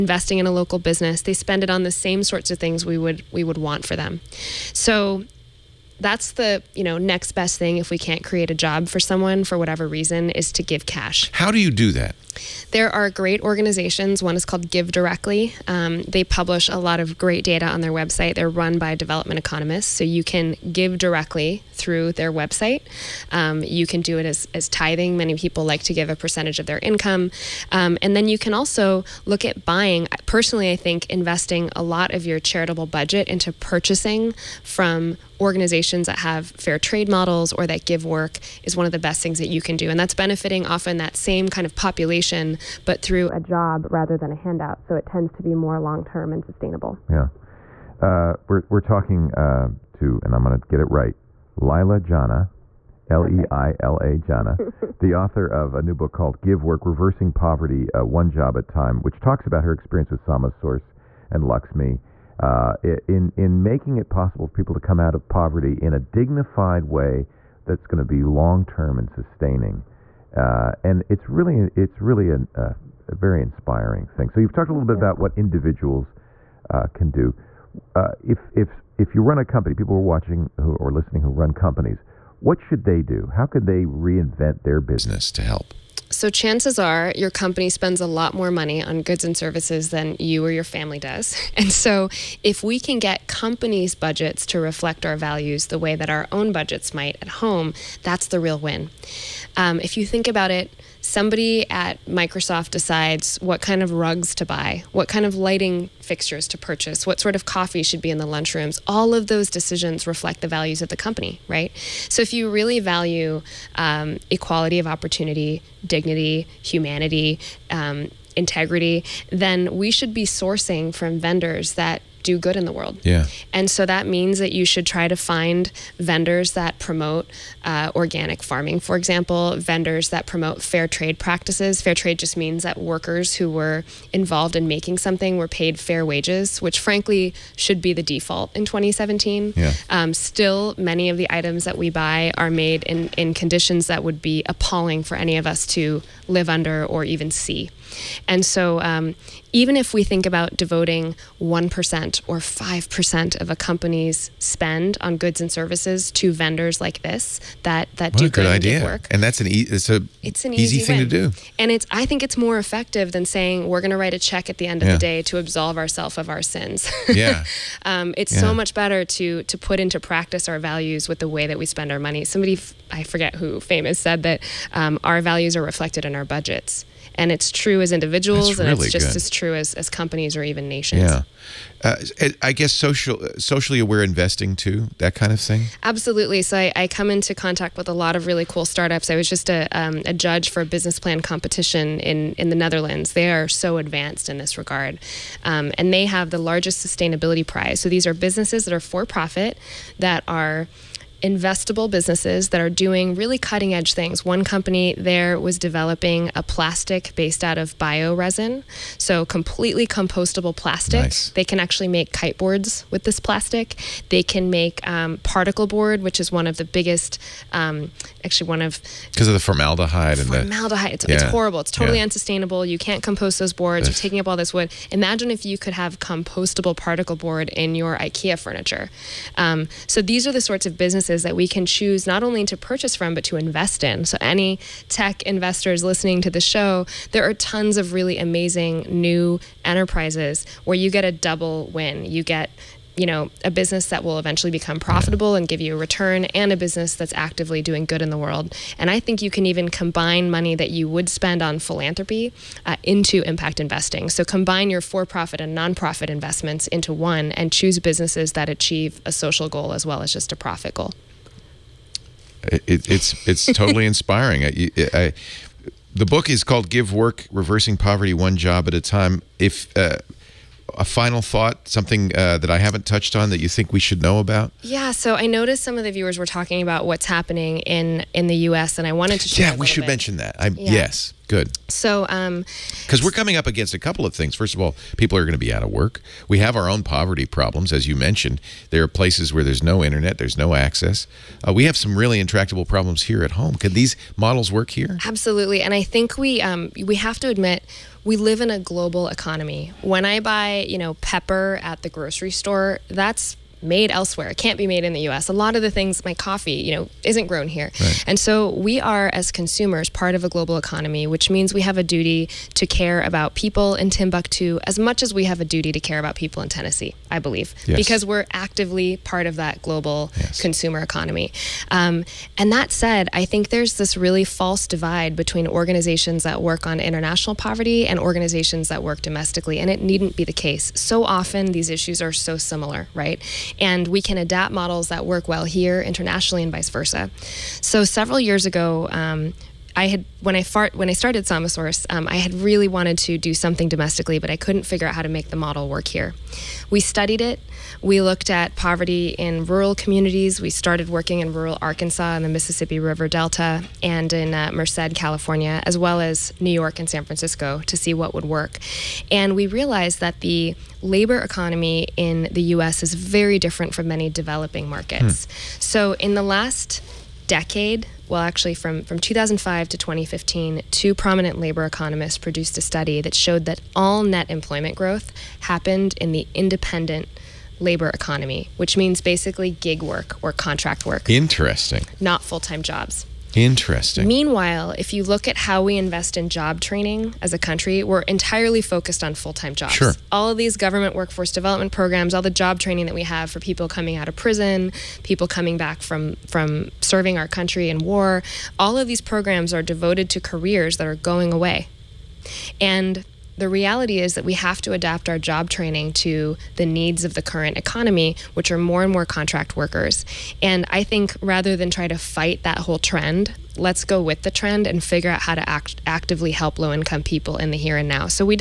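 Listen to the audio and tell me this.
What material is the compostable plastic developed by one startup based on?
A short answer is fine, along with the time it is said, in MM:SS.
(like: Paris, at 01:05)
Bioresin, at 03:27.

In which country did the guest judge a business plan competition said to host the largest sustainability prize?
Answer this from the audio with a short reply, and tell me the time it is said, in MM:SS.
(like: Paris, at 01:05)
The Netherlands, at 03:12.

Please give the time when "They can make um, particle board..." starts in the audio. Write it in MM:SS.
03:34.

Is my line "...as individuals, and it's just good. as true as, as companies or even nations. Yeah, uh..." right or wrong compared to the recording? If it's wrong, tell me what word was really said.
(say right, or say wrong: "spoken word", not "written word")
right.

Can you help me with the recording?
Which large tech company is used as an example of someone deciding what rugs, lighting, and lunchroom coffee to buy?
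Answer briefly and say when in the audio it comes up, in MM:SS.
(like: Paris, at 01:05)
Microsoft, at 01:42.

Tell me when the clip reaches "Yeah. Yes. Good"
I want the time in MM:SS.
04:40.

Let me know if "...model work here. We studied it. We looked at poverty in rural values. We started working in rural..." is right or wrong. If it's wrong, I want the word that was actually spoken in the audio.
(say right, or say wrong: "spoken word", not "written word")
wrong: "communities", not "values".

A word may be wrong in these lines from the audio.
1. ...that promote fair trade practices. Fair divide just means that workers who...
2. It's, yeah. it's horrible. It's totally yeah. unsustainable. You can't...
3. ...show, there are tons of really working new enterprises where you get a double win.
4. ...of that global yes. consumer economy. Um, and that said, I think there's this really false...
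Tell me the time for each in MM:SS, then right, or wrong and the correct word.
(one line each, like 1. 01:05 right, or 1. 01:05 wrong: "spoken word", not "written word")
1. 02:10 wrong: "trade", not "divide"
2. 03:40 right
3. 03:56 wrong: "amazing", not "working"
4. 05:19 right.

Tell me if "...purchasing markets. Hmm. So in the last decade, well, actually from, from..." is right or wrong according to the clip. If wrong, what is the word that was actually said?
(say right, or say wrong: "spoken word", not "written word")
wrong: "developing", not "purchasing".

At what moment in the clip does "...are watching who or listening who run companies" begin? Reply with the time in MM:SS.
01:19.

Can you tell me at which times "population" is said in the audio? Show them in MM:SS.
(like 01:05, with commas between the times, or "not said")
00:41.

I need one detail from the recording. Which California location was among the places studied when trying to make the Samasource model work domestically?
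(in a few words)
Merced.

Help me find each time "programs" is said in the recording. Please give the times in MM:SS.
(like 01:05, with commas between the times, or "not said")
06:31, 06:39.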